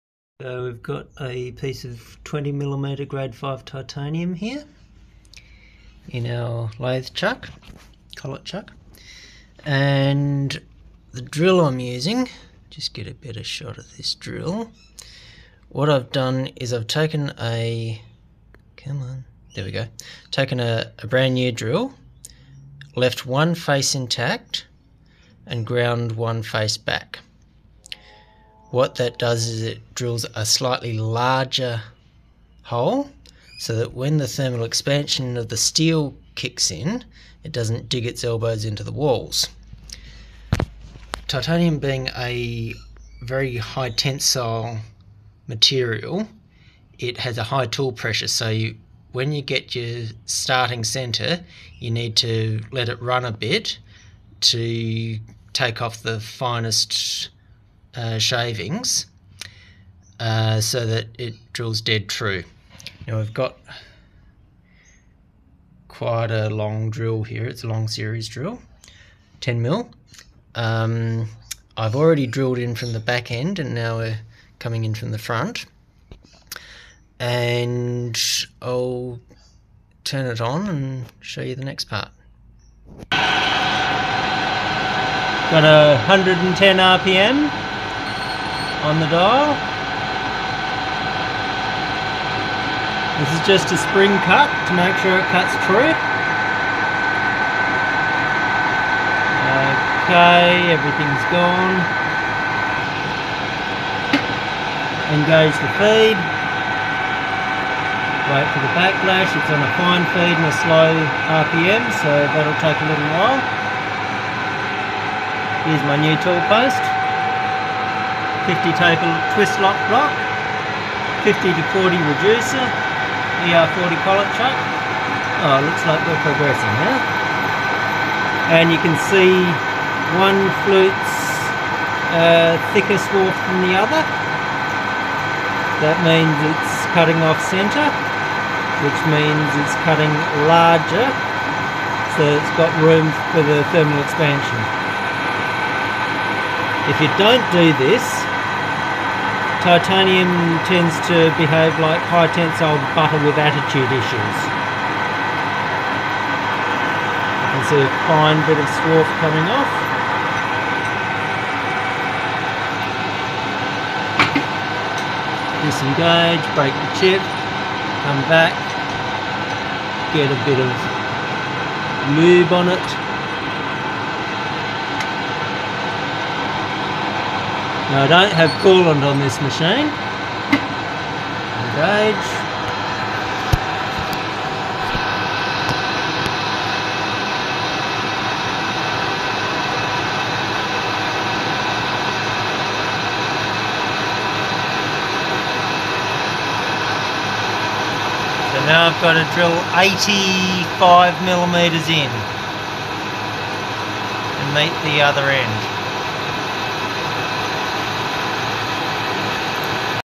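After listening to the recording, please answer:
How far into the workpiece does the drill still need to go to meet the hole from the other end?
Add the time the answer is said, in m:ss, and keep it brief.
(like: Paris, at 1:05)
85 millimeters, at 3:19.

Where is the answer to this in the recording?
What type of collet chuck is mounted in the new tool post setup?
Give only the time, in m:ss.
2:03.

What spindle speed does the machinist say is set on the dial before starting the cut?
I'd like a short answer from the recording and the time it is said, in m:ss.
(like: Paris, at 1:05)
110 RPM, at 1:26.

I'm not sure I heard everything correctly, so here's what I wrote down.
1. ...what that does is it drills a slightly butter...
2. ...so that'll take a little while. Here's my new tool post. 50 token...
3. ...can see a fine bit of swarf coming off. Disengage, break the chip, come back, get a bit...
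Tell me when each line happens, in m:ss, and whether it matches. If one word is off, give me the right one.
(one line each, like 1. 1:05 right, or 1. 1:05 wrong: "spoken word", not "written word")
1. 0:28 wrong: "larger", not "butter"
2. 1:52 right
3. 2:37 right.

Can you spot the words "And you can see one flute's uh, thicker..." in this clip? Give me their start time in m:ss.
2:08.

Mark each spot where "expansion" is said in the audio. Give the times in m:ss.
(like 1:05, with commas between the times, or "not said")
0:34, 2:24.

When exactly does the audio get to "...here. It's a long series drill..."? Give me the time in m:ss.
1:07.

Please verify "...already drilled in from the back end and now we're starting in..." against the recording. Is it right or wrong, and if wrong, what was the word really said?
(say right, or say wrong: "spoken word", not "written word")
wrong: "coming", not "starting".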